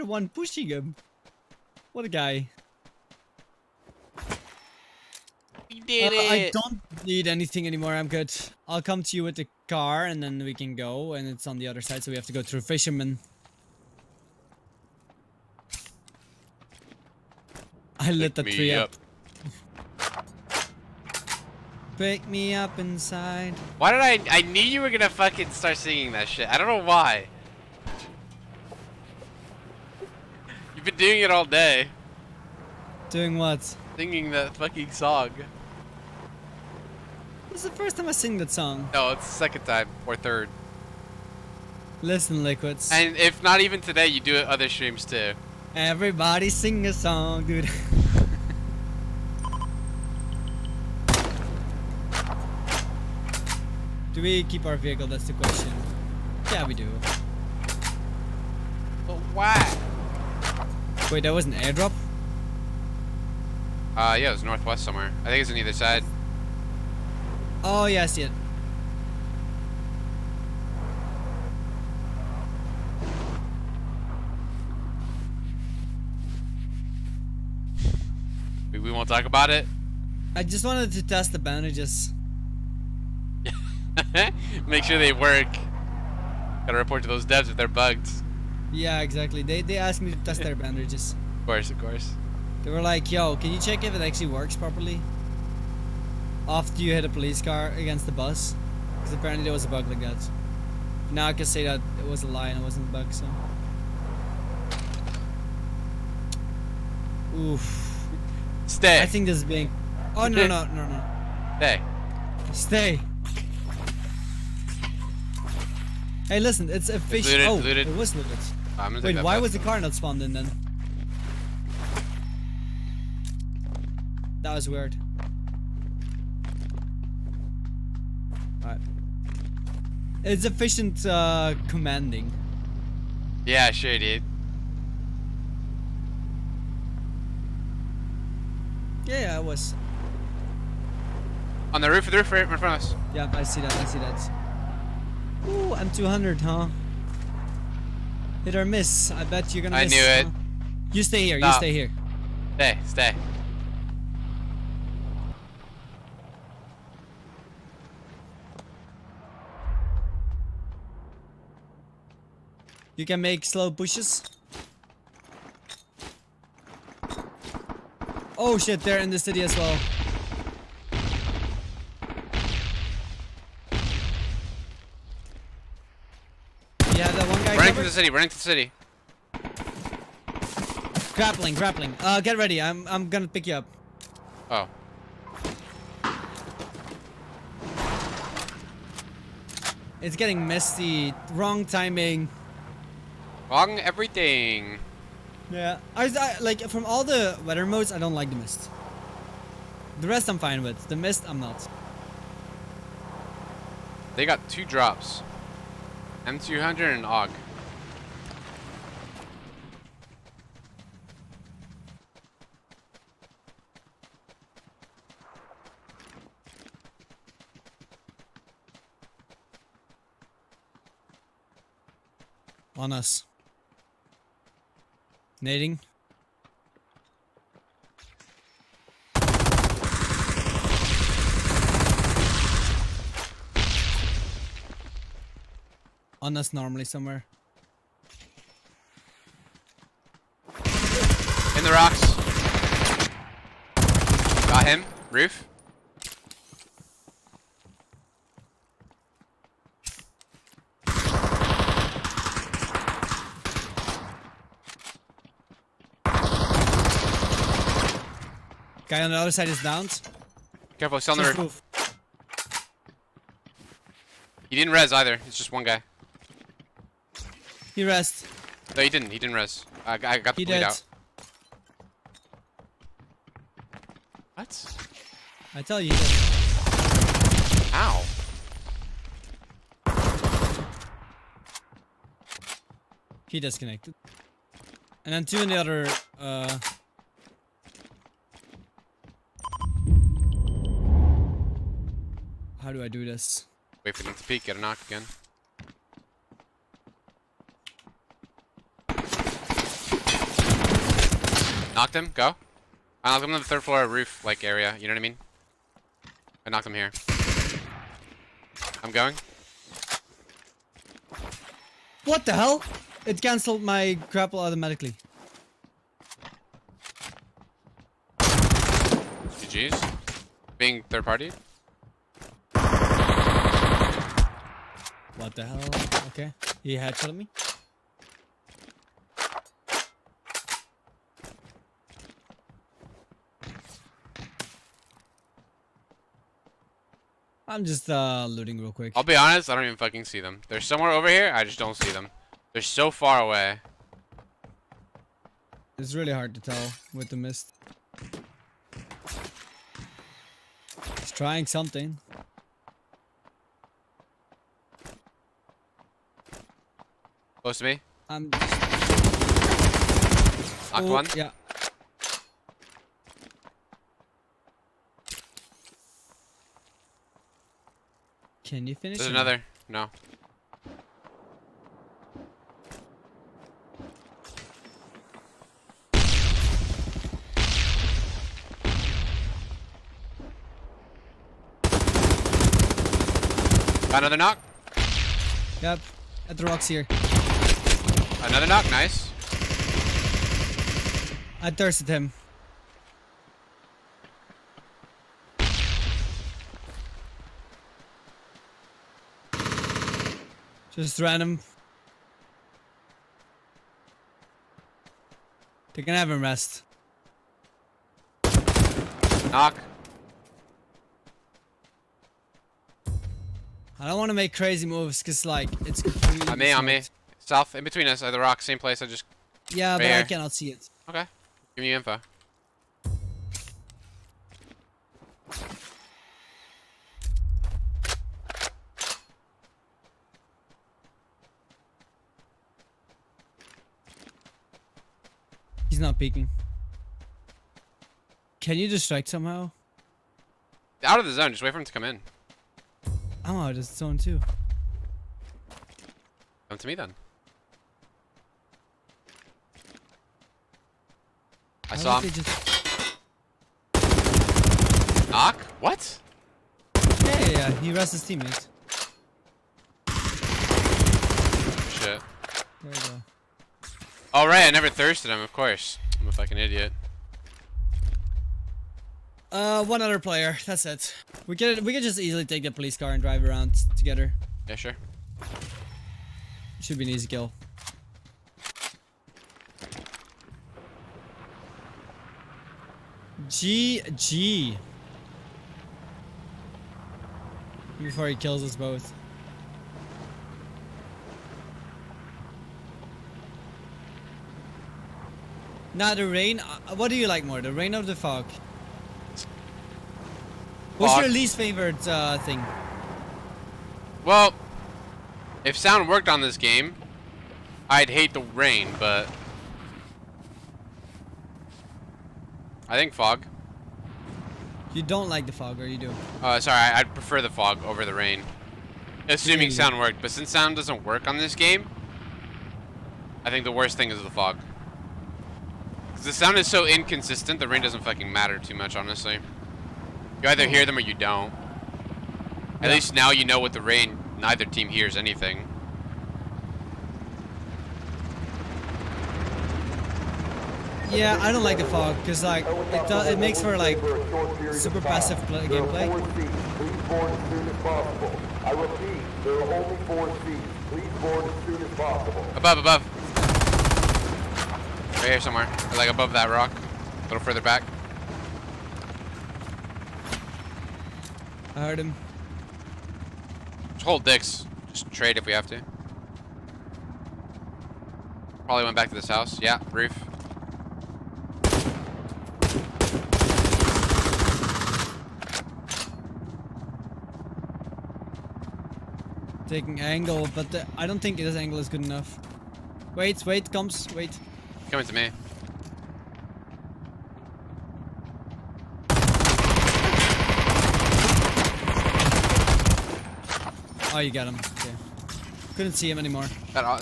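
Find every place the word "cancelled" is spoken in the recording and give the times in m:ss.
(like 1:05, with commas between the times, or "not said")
5:13.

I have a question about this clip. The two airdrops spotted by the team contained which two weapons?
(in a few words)
M200 and AUG.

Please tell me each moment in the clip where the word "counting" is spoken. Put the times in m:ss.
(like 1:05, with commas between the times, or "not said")
not said.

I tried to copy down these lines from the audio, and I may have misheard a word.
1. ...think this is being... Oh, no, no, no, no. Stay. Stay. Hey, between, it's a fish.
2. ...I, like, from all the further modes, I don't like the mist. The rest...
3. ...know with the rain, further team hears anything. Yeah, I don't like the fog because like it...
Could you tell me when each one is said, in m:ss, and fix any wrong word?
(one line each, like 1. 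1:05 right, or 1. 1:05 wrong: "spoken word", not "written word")
1. 1:49 wrong: "listen", not "between"
2. 3:16 wrong: "weather", not "further"
3. 8:53 wrong: "neither", not "further".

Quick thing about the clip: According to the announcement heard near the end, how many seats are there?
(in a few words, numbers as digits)
4.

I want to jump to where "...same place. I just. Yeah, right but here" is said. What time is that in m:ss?
6:58.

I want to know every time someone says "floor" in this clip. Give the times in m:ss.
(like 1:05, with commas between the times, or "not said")
5:03.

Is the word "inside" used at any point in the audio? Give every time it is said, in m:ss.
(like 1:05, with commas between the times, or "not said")
0:22.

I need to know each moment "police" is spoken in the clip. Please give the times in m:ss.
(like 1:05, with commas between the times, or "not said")
1:37, 7:52.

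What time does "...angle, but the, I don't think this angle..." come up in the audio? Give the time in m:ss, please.
9:39.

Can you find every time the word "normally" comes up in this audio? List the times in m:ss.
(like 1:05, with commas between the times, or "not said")
3:56.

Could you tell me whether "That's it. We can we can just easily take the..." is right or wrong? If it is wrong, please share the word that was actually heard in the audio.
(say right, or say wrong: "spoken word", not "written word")
right.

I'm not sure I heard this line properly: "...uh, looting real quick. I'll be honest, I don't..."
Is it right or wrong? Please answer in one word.
right.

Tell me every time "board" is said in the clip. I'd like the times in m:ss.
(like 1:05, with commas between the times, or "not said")
9:10.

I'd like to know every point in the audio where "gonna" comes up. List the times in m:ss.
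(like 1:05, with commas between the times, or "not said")
0:24, 2:29, 3:03.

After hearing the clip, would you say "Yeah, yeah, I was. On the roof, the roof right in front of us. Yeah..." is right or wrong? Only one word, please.
right.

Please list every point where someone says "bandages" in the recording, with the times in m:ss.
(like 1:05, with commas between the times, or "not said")
1:21, 1:30.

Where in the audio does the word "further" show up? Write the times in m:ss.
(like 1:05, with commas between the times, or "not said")
9:17.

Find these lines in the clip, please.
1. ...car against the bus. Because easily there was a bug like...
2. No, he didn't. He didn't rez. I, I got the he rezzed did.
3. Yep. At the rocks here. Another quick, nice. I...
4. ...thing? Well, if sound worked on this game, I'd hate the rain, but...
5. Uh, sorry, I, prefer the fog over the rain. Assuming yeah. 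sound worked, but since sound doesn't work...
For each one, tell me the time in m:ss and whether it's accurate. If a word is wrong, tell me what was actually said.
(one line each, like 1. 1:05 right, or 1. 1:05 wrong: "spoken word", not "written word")
1. 1:37 wrong: "apparently", not "easily"
2. 4:28 wrong: "bleed", not "rezzed"
3. 6:25 wrong: "knock", not "quick"
4. 8:22 right
5. 8:36 right.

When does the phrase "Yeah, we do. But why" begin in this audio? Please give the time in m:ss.
0:56.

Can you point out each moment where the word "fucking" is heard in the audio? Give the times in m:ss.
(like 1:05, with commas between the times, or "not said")
0:25, 0:34, 5:39, 7:46, 8:47.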